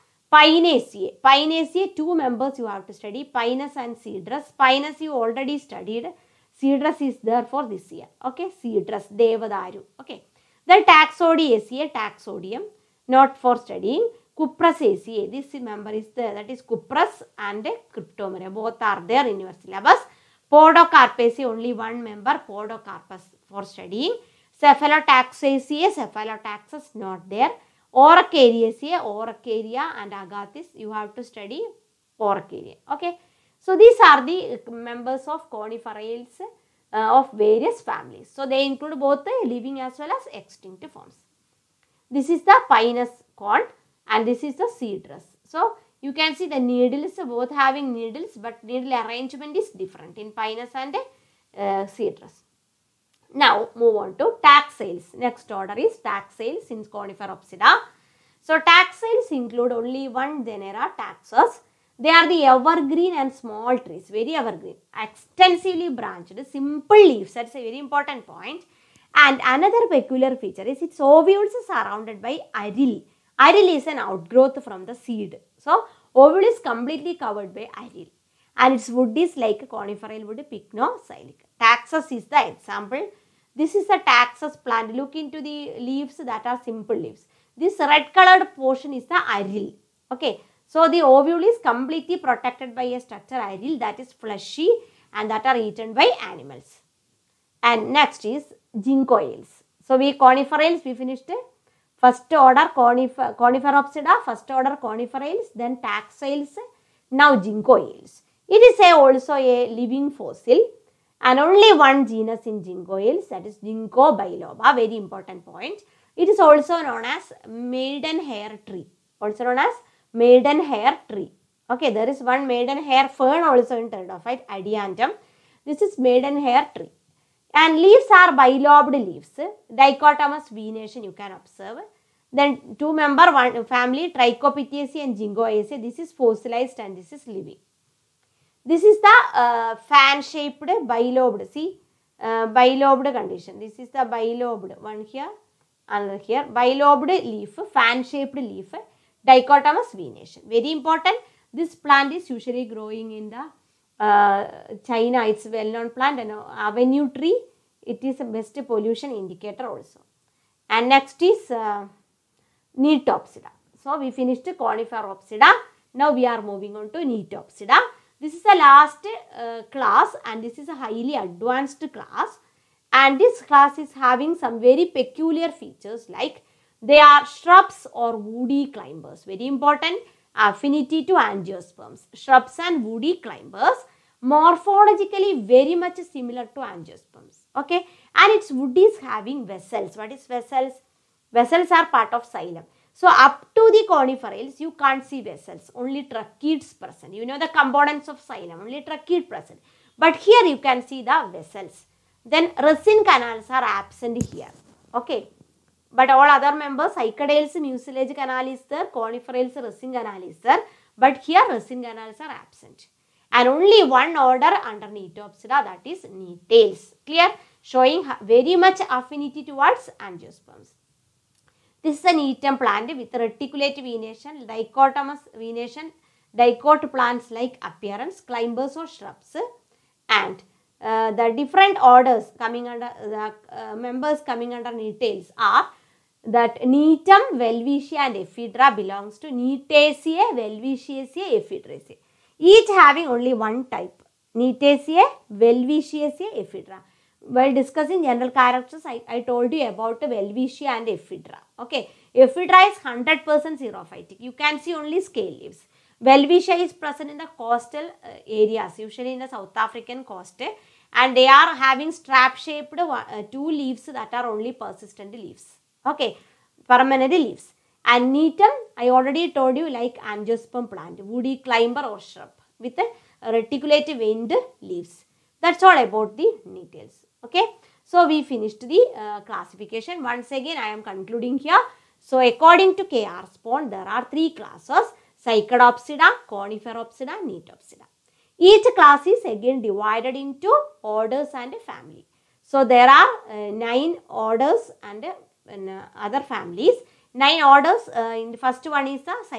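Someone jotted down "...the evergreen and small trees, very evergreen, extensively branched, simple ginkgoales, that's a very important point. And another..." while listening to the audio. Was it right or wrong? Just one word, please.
wrong.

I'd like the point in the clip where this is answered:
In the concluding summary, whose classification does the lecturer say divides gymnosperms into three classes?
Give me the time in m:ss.
4:42.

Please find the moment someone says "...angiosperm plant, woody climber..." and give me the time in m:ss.
4:29.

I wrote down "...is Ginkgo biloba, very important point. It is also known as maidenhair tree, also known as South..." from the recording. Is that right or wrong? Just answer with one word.
wrong.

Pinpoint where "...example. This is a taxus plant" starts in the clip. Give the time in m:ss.
1:22.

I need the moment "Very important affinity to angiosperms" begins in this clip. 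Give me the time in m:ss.
2:59.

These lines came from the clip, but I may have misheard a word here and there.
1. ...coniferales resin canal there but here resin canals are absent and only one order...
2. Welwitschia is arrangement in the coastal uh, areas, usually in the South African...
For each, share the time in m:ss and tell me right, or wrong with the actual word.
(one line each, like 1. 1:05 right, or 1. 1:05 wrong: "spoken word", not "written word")
1. 3:28 right
2. 4:16 wrong: "present", not "arrangement".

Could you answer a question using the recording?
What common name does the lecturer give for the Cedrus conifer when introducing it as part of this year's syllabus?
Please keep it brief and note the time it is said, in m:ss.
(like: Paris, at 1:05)
Devadaru, at 0:09.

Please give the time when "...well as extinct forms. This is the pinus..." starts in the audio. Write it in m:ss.
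0:39.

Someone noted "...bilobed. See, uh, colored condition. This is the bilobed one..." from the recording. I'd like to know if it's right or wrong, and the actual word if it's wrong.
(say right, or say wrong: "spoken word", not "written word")
wrong: "bilobed", not "colored".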